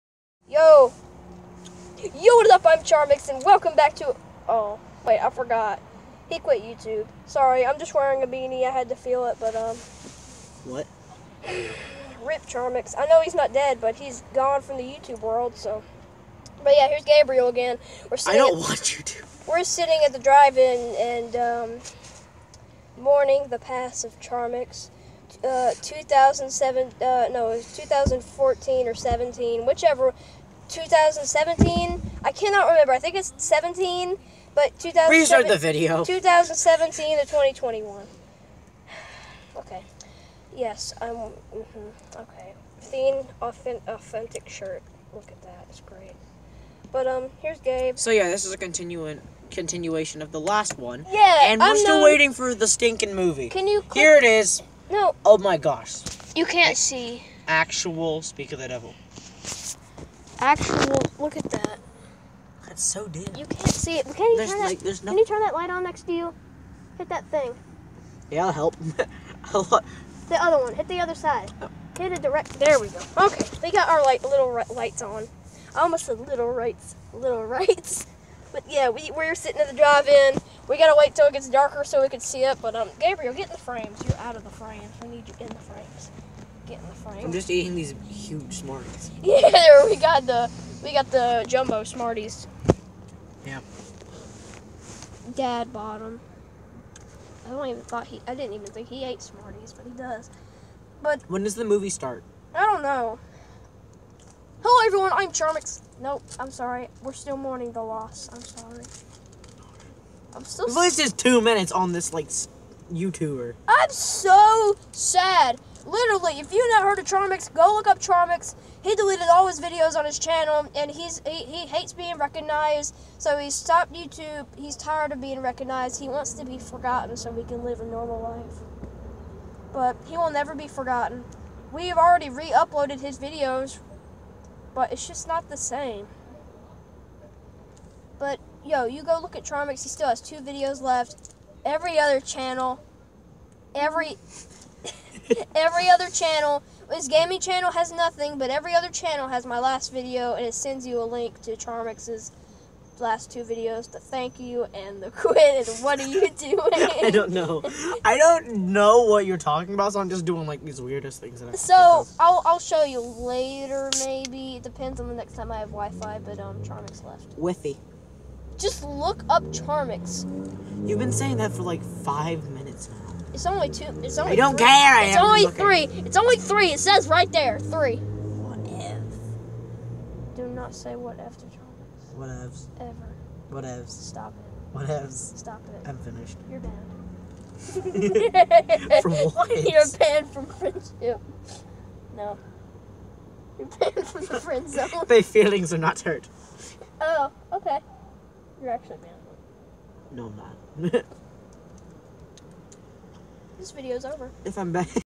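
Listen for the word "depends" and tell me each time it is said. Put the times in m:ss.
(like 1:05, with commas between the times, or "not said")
2:44.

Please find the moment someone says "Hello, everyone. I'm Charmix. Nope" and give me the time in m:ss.
1:44.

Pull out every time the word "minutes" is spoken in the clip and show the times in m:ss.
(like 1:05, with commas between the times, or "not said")
1:51, 2:52.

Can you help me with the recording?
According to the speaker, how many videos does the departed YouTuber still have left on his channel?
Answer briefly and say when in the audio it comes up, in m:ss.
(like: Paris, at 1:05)
2, at 2:20.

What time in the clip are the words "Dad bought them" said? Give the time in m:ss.
1:35.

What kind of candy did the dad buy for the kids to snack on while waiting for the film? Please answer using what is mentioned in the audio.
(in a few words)
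jumbo Smarties.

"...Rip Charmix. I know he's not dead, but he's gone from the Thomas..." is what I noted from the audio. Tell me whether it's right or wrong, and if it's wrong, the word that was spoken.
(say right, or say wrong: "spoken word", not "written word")
wrong: "YouTube", not "Thomas".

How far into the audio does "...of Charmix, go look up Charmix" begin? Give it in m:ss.
1:56.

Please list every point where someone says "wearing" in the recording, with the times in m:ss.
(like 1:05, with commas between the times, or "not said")
0:07.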